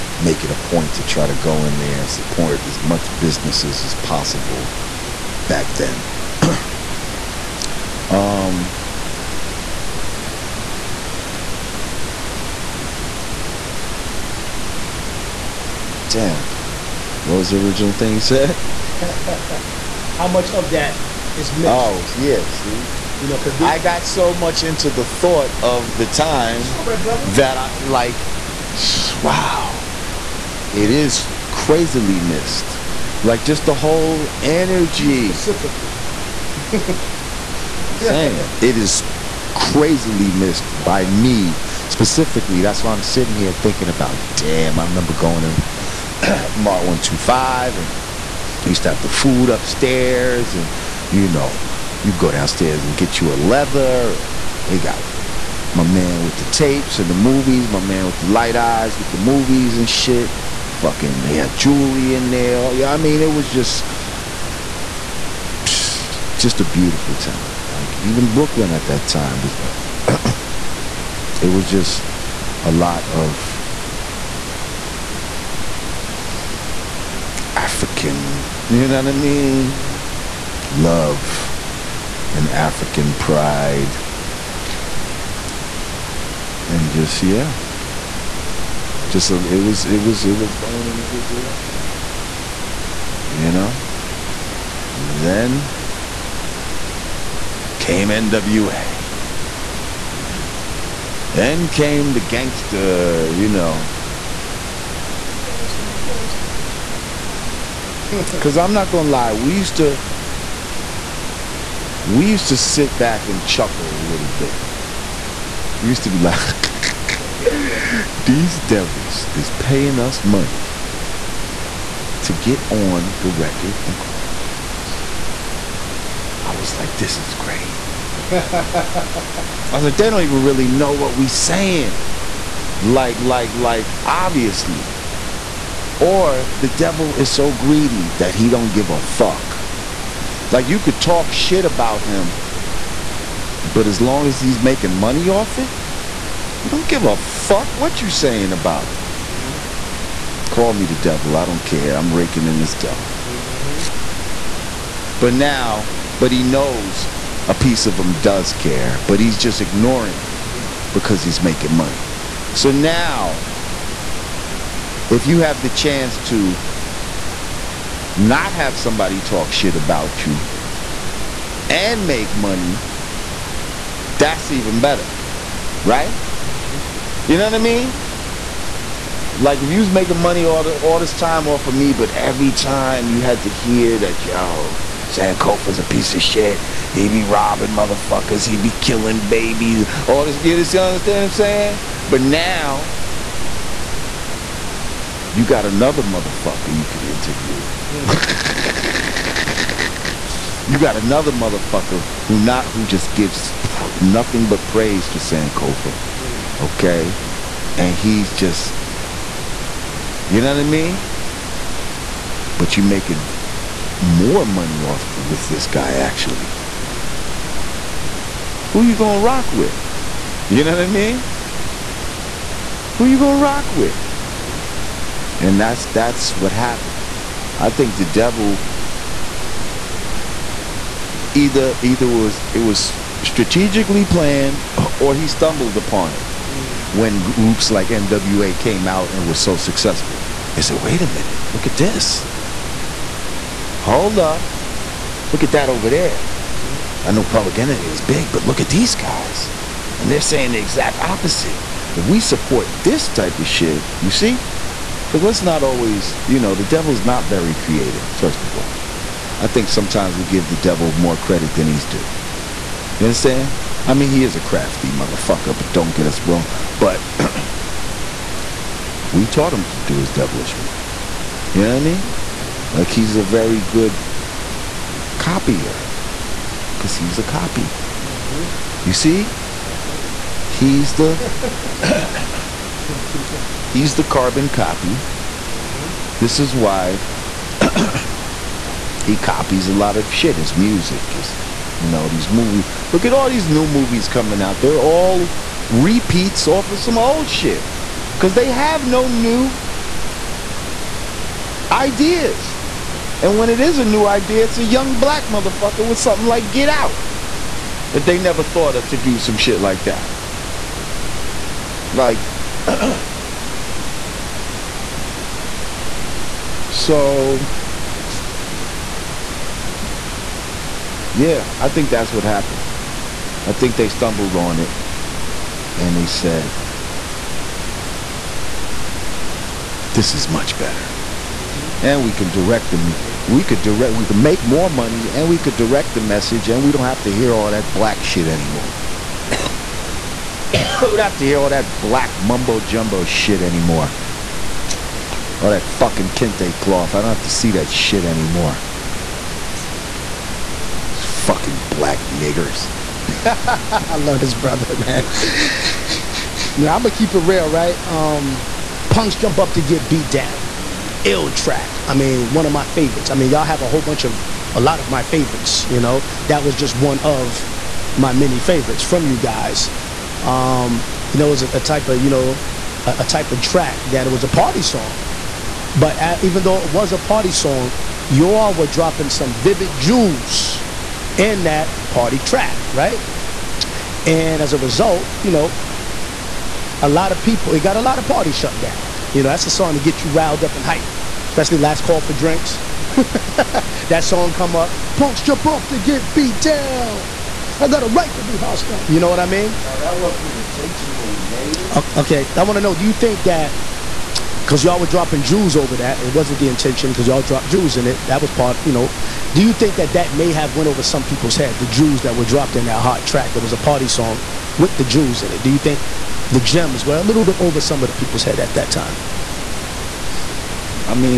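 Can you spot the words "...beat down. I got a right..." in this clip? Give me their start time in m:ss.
6:36.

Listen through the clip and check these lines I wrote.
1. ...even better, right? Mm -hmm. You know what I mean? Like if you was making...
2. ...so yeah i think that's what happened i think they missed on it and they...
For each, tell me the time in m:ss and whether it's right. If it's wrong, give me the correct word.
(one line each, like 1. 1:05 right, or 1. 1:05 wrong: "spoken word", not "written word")
1. 2:54 right
2. 5:16 wrong: "stumbled", not "missed".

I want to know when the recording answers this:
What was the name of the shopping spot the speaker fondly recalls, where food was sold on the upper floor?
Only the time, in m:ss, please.
0:46.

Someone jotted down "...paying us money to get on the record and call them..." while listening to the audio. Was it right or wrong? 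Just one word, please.
right.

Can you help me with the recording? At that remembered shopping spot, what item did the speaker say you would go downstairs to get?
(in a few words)
leather.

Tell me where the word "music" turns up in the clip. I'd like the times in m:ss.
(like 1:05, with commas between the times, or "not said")
4:50.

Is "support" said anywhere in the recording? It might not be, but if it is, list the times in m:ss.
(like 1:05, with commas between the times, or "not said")
0:02, 4:12.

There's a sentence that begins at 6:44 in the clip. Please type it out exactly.
Because y'all were dropping Jews over that, it wasn't the intention.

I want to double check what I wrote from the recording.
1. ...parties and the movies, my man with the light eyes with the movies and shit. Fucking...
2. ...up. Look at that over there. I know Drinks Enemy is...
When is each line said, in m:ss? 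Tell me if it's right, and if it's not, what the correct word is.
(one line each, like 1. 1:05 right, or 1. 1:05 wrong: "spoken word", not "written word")
1. 0:56 wrong: "tapes", not "parties"
2. 4:04 wrong: "Public", not "Drinks".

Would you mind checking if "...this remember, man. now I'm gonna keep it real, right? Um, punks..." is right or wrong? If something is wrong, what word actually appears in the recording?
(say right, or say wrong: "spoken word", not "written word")
wrong: "brother", not "remember".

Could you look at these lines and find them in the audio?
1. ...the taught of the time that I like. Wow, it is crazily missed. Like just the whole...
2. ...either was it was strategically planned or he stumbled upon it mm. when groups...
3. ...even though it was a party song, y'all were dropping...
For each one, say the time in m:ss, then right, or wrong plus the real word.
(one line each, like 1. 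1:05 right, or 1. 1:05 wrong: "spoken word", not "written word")
1. 0:24 wrong: "thought", not "taught"
2. 3:51 right
3. 6:16 right.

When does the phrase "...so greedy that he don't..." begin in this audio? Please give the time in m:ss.
2:17.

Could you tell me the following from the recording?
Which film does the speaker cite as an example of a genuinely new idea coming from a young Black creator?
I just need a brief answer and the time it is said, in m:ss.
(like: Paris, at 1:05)
Get Out, at 5:06.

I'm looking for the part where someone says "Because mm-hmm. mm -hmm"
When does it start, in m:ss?
4:58.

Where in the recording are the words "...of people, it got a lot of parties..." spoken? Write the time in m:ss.
6:27.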